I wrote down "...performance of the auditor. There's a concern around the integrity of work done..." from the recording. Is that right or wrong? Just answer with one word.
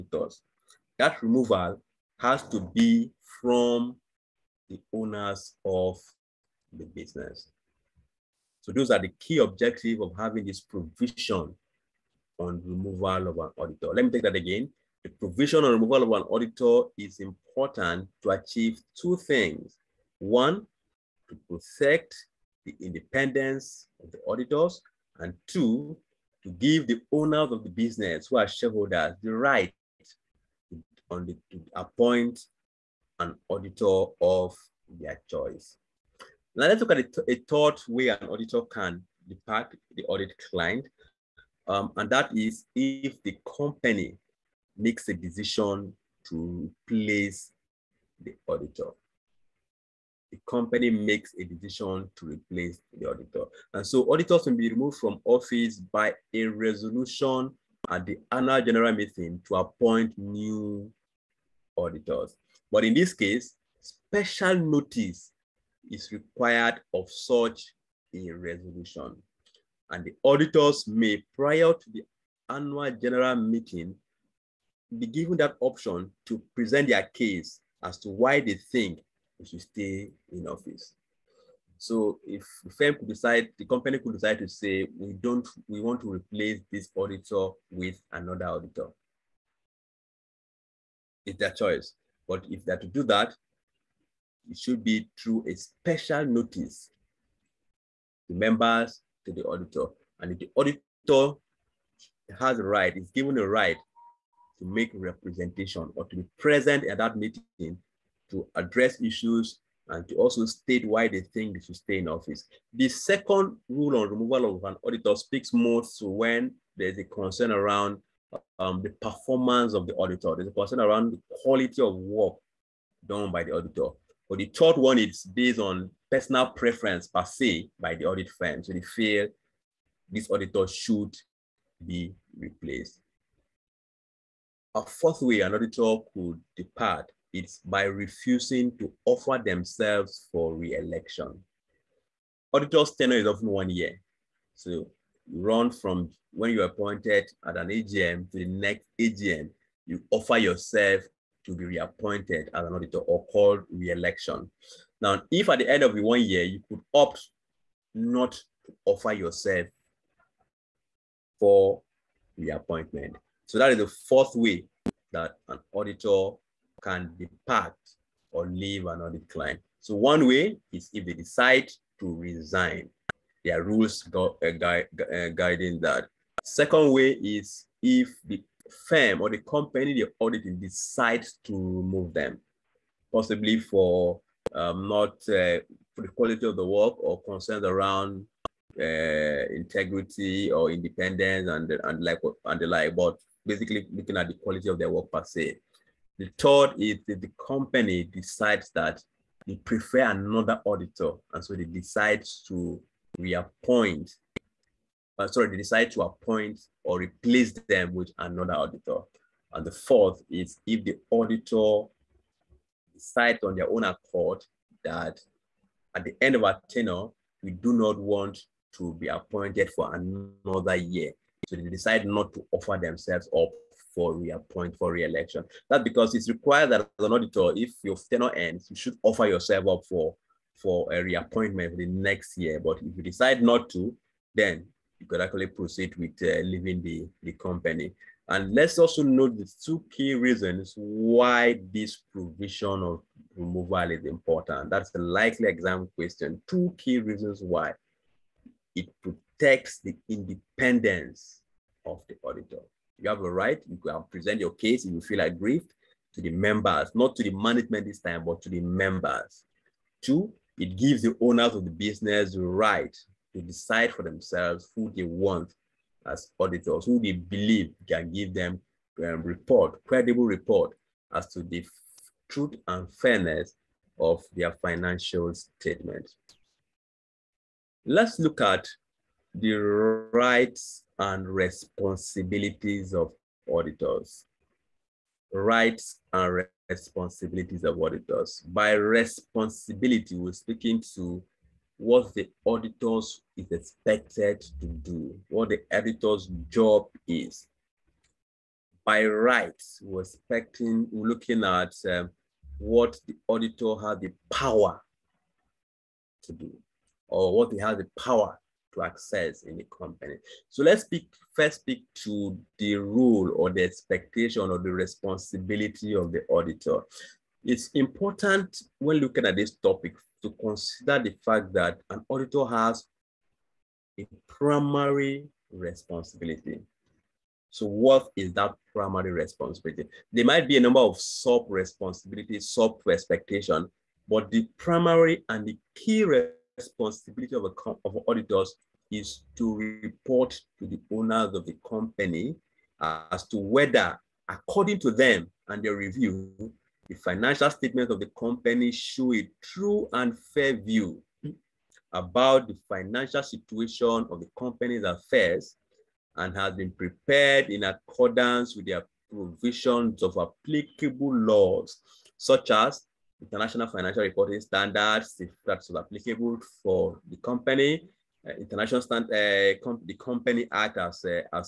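wrong.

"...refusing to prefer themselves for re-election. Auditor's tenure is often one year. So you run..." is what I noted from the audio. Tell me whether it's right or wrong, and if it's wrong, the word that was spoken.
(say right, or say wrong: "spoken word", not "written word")
wrong: "offer", not "prefer".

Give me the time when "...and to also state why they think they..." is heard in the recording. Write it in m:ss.
1:49.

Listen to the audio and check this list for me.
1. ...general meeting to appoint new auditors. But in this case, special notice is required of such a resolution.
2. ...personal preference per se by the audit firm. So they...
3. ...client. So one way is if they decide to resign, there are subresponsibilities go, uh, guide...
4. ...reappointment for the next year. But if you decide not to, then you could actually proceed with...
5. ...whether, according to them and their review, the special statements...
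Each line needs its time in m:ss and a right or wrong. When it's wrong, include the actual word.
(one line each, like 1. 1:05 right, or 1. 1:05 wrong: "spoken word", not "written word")
1. 0:58 right
2. 2:06 right
3. 2:49 wrong: "rules", not "subresponsibilities"
4. 3:51 right
5. 5:43 wrong: "financial", not "special".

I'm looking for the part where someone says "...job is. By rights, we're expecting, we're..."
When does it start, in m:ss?
4:56.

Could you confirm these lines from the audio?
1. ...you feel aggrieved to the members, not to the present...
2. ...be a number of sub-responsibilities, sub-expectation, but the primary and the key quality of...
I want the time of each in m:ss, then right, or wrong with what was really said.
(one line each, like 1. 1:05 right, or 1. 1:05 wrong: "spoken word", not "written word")
1. 4:14 wrong: "management", not "present"
2. 5:30 wrong: "responsibility", not "quality".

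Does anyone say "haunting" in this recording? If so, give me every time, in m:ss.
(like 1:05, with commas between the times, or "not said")
not said.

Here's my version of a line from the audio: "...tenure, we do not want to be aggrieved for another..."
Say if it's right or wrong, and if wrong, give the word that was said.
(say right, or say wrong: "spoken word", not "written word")
wrong: "appointed", not "aggrieved".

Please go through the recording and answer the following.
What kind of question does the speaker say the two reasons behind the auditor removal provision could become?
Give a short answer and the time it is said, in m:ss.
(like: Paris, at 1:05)
Exam question, at 4:05.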